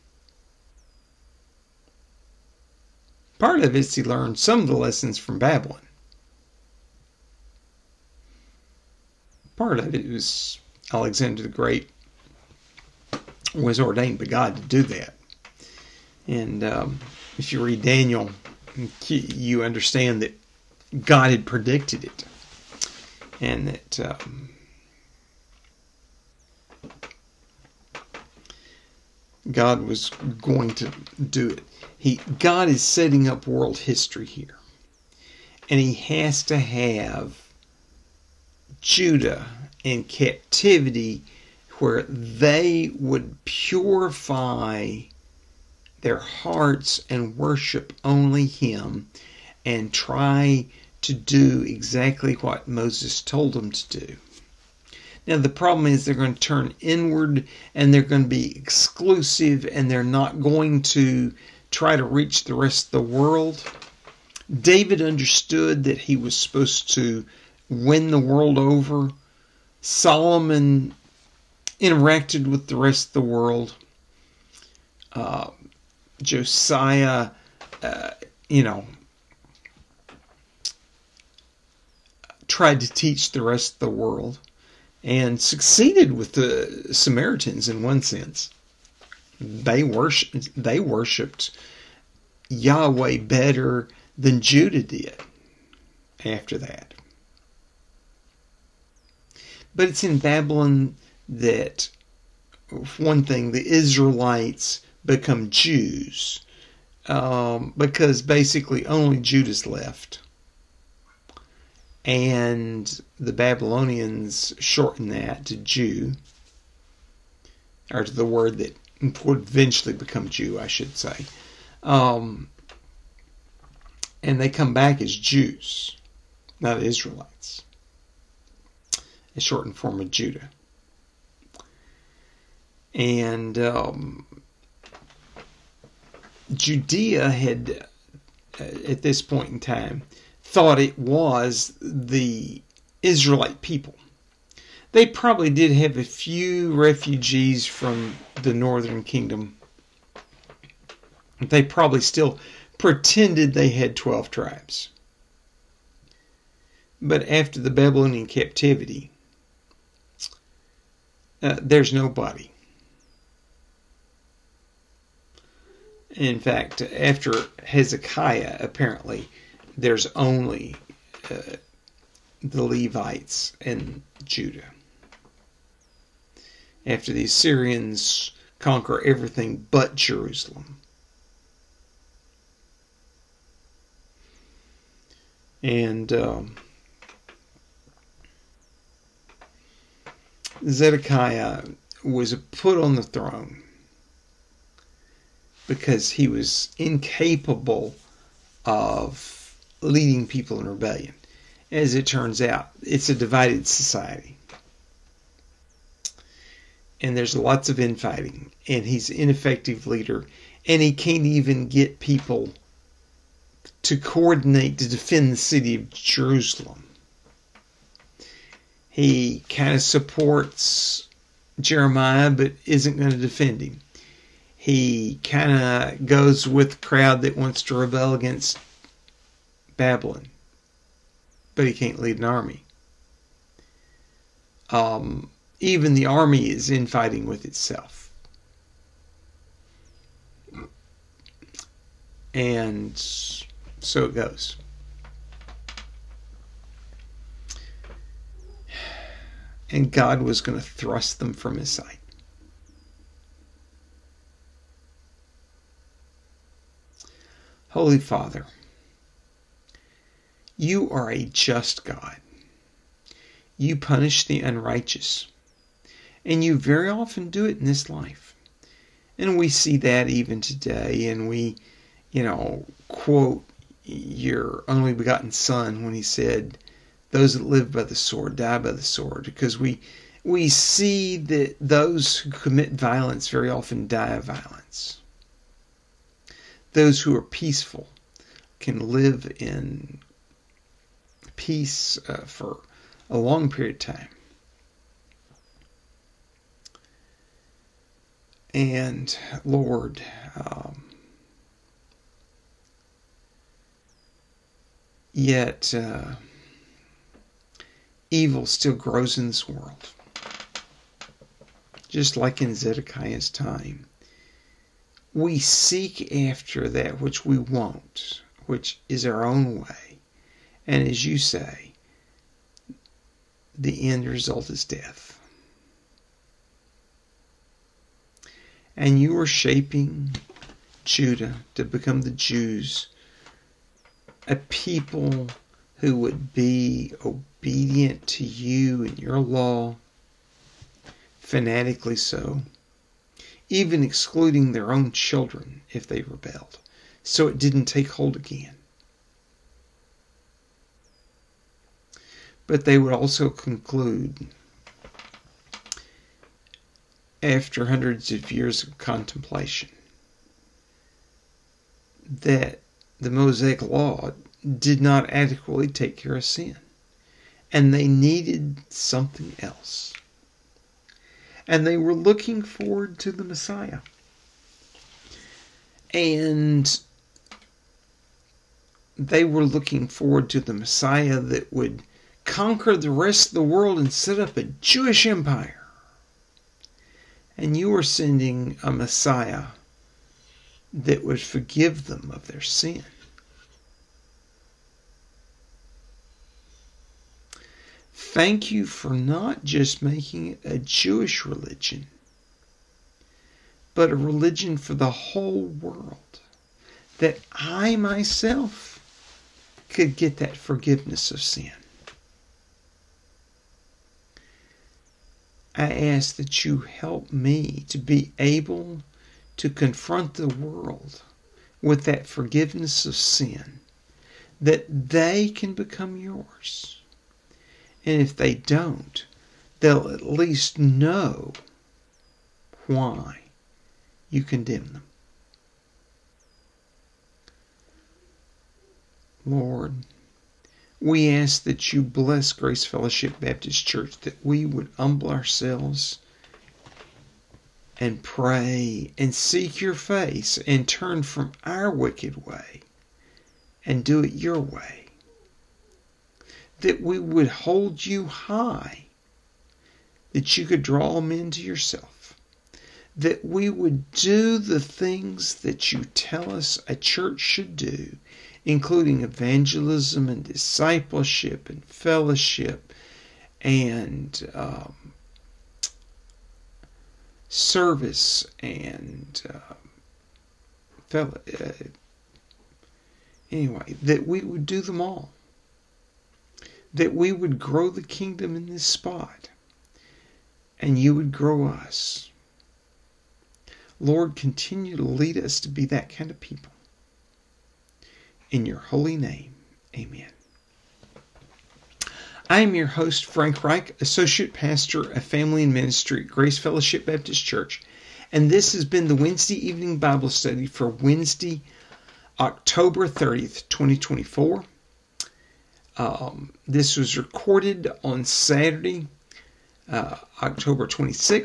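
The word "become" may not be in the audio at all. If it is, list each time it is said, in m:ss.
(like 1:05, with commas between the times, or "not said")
1:45, 1:59, 5:31, 7:05.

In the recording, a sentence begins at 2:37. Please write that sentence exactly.
But after the Babylonian captivity, uh, there's nobody.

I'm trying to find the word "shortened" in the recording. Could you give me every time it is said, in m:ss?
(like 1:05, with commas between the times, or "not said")
1:54, 2:09.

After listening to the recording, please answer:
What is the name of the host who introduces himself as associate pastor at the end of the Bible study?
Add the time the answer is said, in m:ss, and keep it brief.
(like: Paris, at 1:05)
Frank Rike, at 8:23.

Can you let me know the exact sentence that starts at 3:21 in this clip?
As it turns out, it's a divided society.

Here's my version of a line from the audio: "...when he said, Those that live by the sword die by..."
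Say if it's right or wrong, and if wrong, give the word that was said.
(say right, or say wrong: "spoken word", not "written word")
right.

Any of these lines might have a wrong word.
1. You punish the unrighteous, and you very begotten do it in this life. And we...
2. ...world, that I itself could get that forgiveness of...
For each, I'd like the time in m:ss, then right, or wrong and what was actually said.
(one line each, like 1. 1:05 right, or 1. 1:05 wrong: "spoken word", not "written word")
1. 4:23 wrong: "often", not "begotten"
2. 6:45 wrong: "myself", not "itself".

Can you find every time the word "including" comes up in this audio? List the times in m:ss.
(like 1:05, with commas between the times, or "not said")
7:48.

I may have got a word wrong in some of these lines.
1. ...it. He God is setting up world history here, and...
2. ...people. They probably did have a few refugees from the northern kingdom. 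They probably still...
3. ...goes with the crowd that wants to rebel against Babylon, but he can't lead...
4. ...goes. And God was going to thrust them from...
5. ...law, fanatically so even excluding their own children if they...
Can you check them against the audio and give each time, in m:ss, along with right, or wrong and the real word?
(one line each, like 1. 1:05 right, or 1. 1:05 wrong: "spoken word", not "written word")
1. 0:31 right
2. 2:23 right
3. 3:46 right
4. 4:04 right
5. 5:39 right.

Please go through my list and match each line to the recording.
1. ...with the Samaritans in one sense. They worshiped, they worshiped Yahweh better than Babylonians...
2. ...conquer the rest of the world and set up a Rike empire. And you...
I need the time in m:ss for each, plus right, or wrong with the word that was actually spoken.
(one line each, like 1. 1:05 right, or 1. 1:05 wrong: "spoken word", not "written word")
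1. 1:26 wrong: "Judah", not "Babylonians"
2. 6:22 wrong: "Jewish", not "Rike".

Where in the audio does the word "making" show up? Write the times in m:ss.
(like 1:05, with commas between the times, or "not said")
6:39.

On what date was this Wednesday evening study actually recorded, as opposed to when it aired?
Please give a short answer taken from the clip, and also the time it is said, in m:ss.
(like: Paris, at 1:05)
October 26th, at 8:40.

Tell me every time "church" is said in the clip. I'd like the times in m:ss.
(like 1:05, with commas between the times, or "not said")
7:23, 7:46, 8:27.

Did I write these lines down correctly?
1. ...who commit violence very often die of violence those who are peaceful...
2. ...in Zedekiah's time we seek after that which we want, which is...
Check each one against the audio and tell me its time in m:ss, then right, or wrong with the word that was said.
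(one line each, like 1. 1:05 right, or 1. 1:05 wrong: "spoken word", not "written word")
1. 4:42 right
2. 5:12 right.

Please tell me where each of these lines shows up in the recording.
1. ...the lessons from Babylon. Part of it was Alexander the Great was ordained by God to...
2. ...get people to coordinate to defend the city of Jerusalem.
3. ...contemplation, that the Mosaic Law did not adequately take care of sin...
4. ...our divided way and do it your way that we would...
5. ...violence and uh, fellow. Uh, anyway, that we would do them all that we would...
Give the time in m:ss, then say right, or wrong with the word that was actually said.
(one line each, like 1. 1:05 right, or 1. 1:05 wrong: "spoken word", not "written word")
1. 0:04 right
2. 3:31 right
3. 5:58 right
4. 7:31 wrong: "wicked", not "divided"
5. 7:57 wrong: "service", not "violence".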